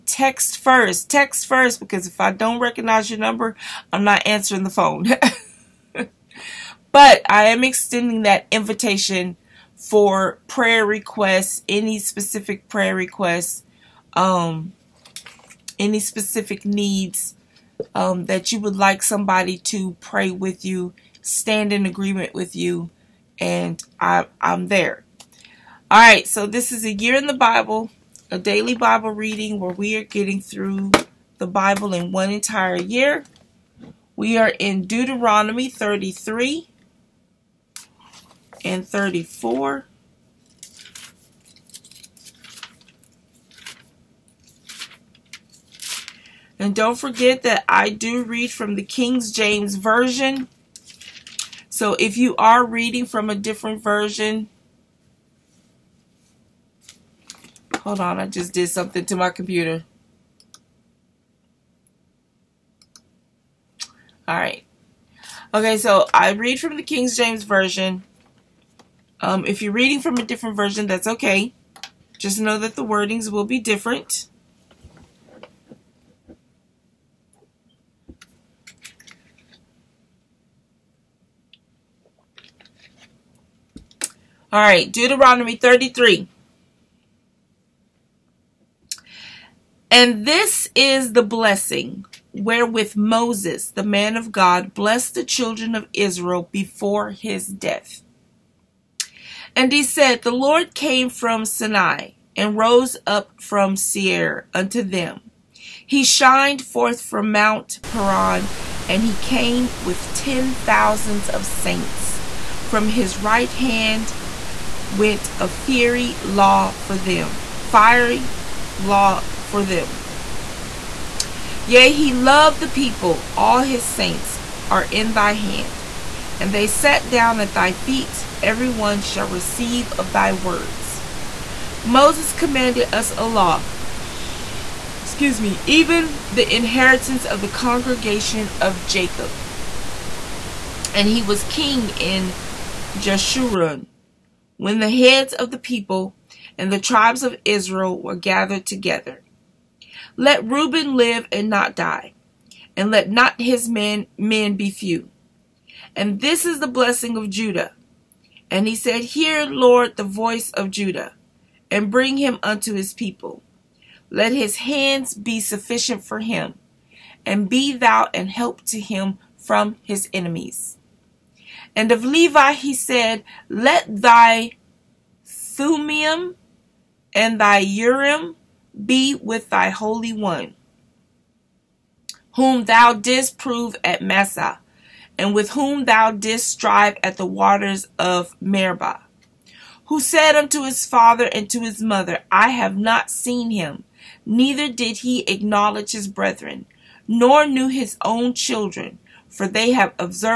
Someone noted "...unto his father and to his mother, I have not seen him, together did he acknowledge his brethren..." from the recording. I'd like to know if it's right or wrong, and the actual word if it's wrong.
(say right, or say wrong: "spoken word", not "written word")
wrong: "neither", not "together".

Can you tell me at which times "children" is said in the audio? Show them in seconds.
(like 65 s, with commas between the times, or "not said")
95 s, 198 s.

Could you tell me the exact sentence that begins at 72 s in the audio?
Just know that the wordings will be different.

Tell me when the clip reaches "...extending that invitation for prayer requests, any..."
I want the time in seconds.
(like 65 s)
7 s.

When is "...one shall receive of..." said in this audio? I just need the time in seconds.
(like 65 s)
128 s.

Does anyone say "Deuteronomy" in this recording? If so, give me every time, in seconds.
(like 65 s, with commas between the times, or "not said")
34 s, 84 s.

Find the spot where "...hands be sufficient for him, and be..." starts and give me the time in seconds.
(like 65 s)
164 s.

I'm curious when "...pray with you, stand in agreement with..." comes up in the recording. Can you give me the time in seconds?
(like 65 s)
19 s.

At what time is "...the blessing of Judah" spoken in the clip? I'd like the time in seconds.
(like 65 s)
156 s.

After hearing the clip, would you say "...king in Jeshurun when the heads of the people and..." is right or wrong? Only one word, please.
right.